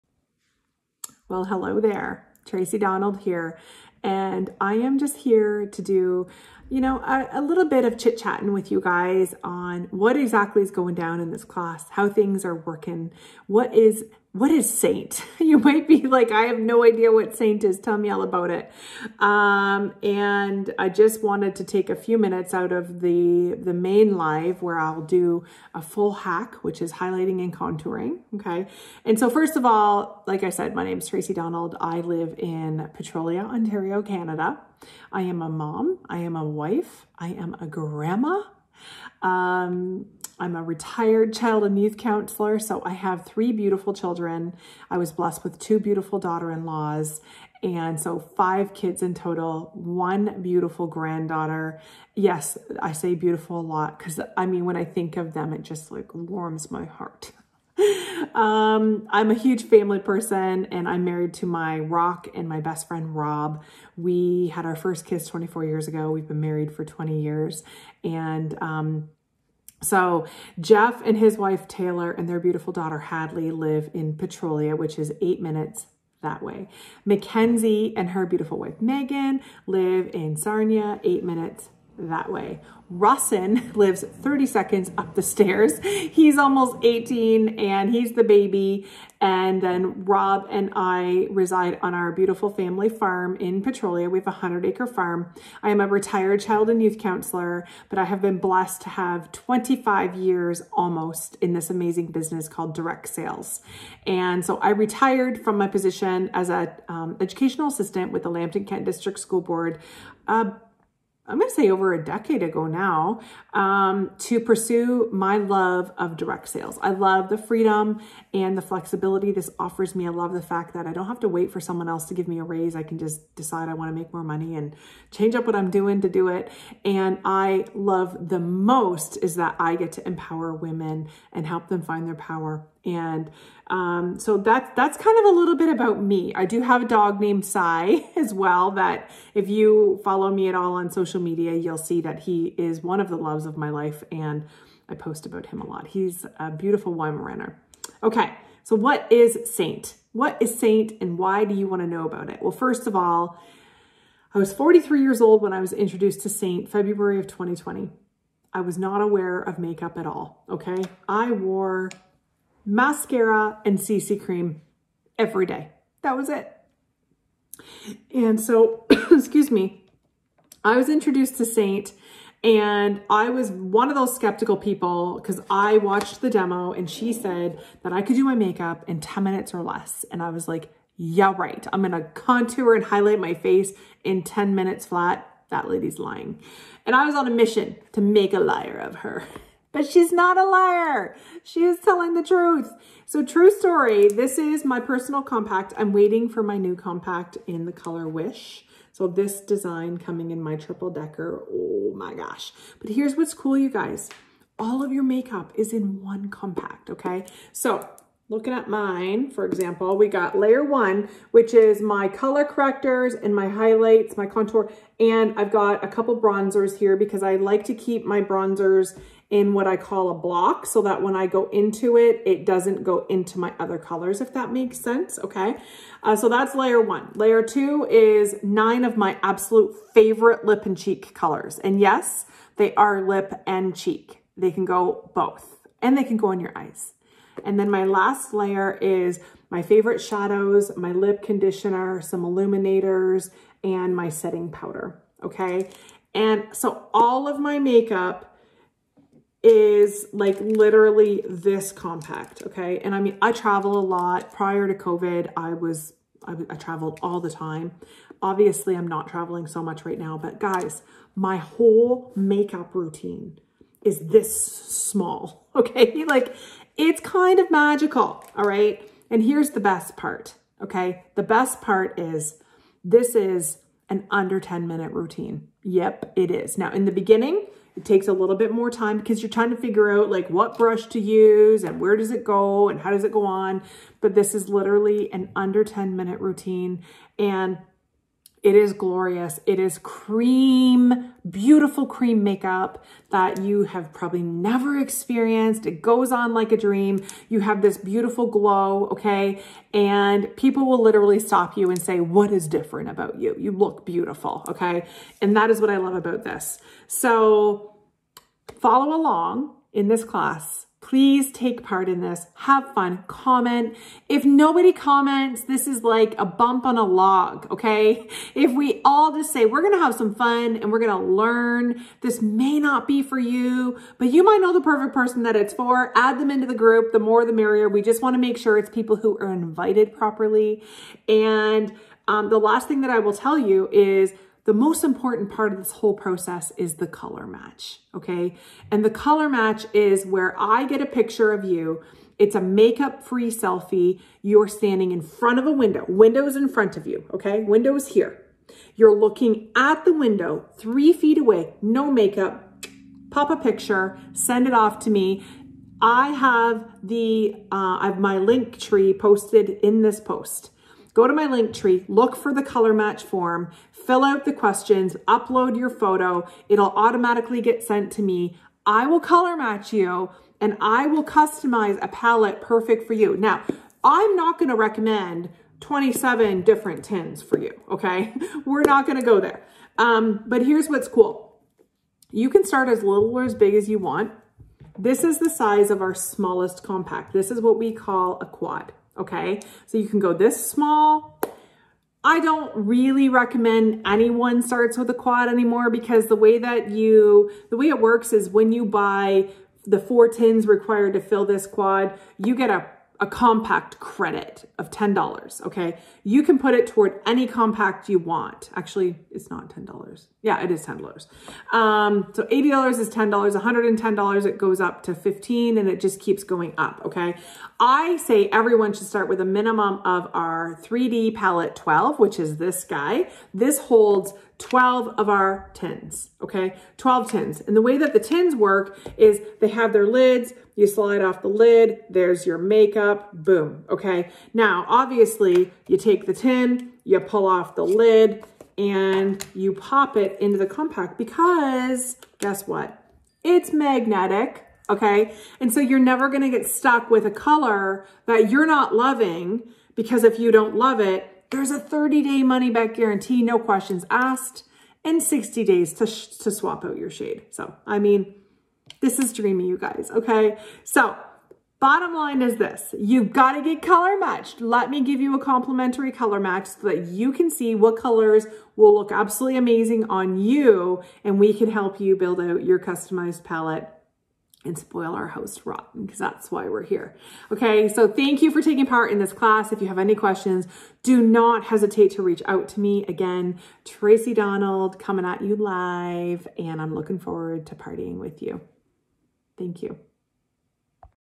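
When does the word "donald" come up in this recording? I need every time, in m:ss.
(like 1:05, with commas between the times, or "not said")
0:02, 0:31, 8:04.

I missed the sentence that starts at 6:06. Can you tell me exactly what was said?
It'll automatically get sent to me.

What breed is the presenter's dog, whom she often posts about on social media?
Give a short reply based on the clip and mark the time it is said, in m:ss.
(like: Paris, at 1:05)
Weimaraner, at 2:26.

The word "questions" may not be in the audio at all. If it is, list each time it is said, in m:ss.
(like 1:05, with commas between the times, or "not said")
6:04, 7:33, 7:59.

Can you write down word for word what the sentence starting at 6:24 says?
This is the size of our smallest compact.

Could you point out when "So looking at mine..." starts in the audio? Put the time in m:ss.
3:27.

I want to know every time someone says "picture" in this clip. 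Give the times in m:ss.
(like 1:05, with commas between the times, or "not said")
5:40, 5:53.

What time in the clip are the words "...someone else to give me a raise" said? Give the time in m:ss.
2:01.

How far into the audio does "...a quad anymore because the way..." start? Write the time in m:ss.
6:34.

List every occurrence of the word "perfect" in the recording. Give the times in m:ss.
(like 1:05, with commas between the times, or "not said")
5:24, 6:12.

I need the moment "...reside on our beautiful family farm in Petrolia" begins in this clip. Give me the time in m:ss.
1:31.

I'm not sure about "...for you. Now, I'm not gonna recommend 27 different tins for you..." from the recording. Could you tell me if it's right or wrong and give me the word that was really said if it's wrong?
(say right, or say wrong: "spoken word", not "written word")
right.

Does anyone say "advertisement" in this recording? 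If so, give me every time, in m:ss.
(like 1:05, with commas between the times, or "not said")
not said.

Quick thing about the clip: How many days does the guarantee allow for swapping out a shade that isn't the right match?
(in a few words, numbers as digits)
60.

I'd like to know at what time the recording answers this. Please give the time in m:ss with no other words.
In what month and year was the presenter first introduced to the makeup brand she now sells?
2:36.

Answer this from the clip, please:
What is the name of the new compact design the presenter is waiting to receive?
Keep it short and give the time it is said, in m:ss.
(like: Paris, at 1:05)
Wish, at 3:18.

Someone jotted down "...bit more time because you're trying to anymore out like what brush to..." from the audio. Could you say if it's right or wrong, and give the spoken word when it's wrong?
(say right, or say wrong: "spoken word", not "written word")
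wrong: "figure", not "anymore".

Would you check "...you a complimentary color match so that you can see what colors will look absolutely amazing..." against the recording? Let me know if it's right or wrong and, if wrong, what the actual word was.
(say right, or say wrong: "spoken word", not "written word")
right.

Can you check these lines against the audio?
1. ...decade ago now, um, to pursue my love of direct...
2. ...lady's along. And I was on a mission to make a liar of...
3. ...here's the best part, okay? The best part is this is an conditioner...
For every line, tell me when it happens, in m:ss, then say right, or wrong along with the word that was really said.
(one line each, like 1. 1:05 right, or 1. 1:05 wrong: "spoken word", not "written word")
1. 1:52 right
2. 3:05 wrong: "lying", not "along"
3. 4:29 wrong: "under", not "conditioner".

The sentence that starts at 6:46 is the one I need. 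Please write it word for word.
You can put it toward any compact you want.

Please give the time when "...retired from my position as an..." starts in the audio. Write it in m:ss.
1:44.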